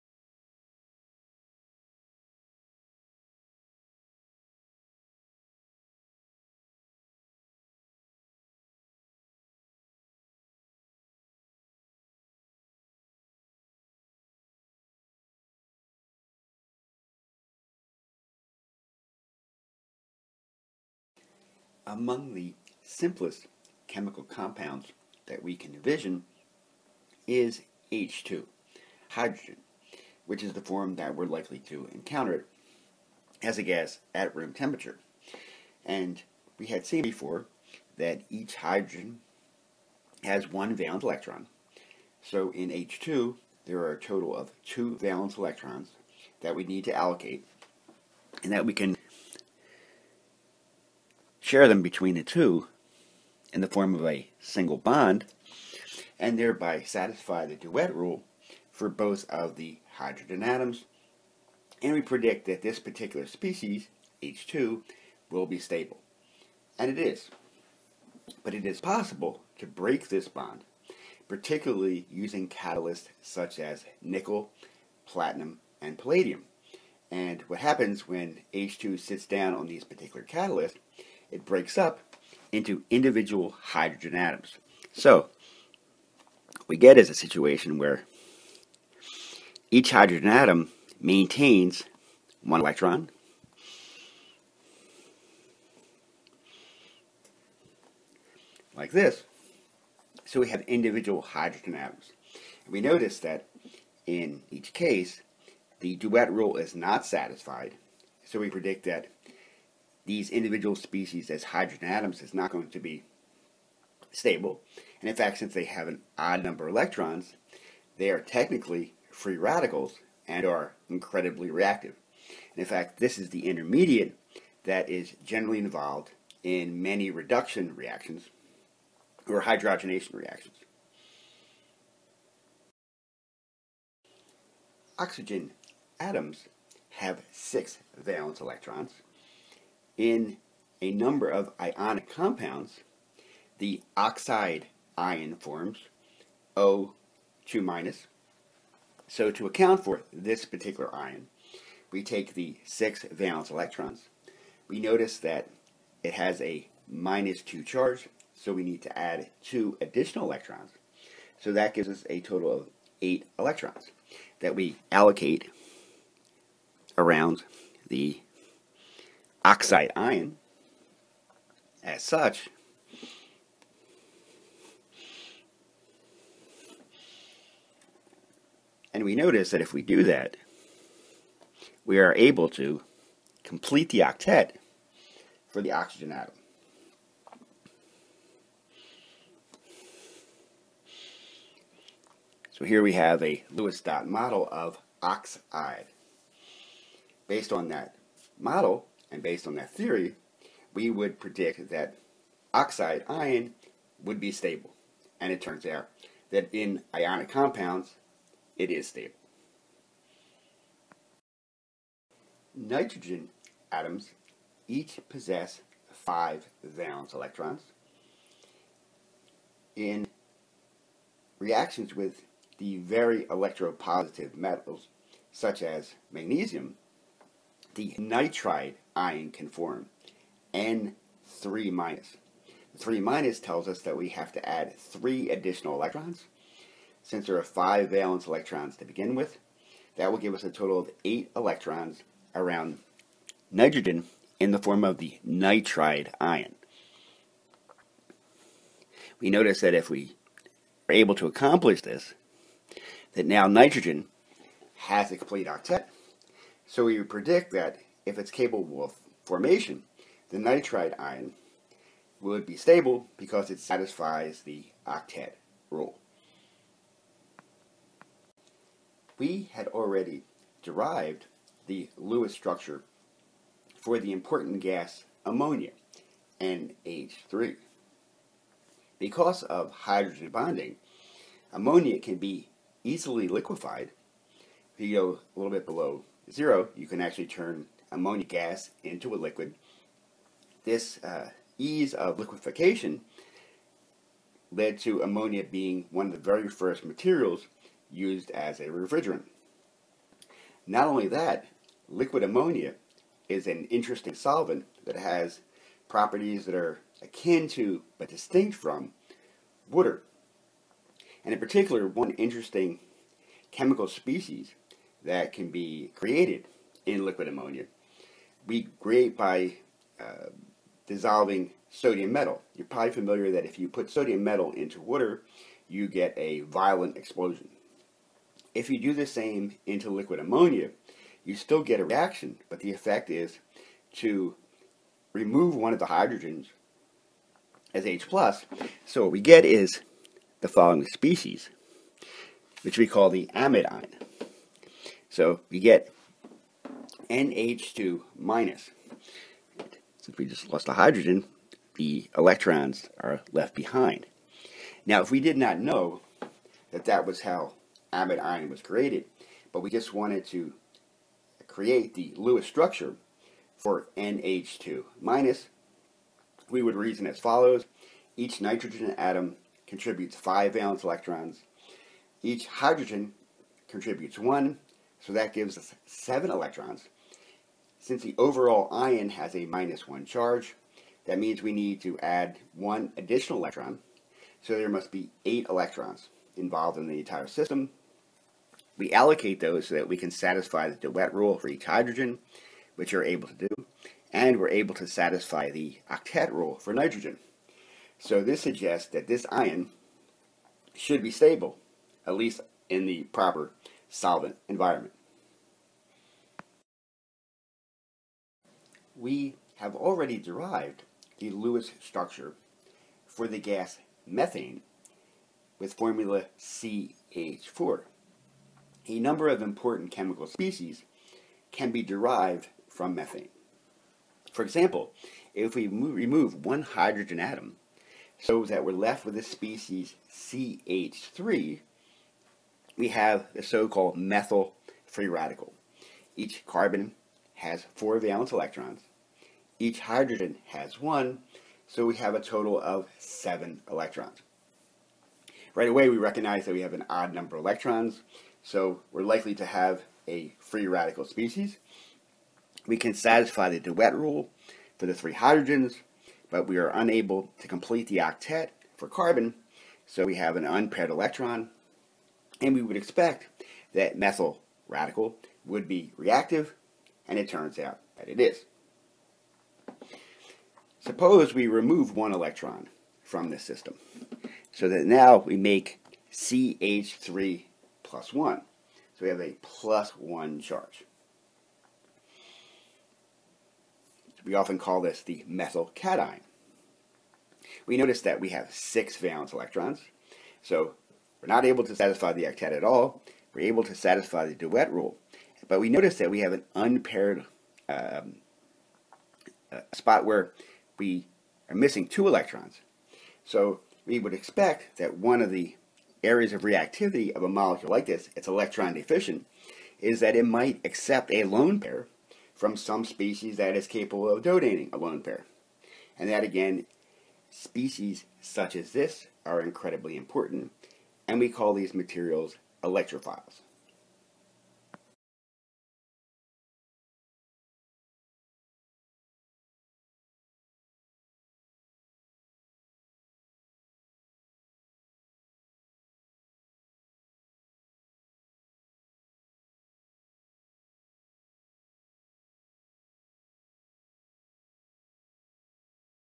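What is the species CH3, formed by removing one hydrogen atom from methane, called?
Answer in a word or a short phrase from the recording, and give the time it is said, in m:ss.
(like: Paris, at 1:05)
methyl free radical, at 7:13.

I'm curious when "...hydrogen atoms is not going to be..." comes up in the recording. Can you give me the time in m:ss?
1:51.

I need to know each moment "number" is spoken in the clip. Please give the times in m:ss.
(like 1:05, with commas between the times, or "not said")
1:56, 2:20, 6:58, 7:27.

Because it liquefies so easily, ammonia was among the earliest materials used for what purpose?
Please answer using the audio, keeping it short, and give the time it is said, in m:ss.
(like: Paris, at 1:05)
refrigerant, at 4:58.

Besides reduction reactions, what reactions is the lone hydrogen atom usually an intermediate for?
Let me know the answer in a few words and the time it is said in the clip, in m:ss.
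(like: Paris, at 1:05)
hydrogenation reactions, at 2:09.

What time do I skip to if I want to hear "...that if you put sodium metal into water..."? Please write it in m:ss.
5:23.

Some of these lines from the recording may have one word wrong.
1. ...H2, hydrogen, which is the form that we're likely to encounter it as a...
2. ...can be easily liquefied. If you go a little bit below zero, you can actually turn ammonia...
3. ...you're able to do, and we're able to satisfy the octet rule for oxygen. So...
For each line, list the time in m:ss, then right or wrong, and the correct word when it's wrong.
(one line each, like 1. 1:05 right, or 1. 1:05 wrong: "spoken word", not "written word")
1. 0:27 right
2. 4:41 right
3. 6:32 wrong: "nitrogen", not "oxygen".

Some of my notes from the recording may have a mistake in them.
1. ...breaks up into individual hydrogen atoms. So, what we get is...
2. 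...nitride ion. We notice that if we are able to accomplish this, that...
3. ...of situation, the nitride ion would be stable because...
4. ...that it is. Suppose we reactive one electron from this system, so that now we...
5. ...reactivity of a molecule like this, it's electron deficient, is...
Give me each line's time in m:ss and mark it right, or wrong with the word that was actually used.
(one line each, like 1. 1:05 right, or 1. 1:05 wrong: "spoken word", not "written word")
1. 1:21 right
2. 4:05 right
3. 4:18 wrong: "formation", not "situation"
4. 7:47 wrong: "remove", not "reactive"
5. 8:26 right.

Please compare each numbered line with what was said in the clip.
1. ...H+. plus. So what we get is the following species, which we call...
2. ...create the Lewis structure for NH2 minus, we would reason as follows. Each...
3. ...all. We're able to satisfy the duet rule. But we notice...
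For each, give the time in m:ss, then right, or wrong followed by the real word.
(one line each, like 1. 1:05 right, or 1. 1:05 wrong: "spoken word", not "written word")
1. 5:37 right
2. 6:01 right
3. 8:12 right.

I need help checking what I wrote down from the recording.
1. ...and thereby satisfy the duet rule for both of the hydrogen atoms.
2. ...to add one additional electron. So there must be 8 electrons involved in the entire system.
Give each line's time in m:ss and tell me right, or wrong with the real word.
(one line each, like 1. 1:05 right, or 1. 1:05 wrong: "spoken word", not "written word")
1. 0:56 right
2. 6:21 right.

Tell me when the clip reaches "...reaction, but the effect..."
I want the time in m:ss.
5:31.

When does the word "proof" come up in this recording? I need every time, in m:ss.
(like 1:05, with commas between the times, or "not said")
not said.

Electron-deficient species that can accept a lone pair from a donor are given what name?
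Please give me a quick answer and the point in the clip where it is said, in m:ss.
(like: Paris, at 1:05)
electrophiles, at 8:42.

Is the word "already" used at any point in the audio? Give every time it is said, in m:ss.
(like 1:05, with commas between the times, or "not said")
4:29, 6:49.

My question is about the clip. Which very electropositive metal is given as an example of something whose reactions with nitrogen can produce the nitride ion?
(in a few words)
magnesium.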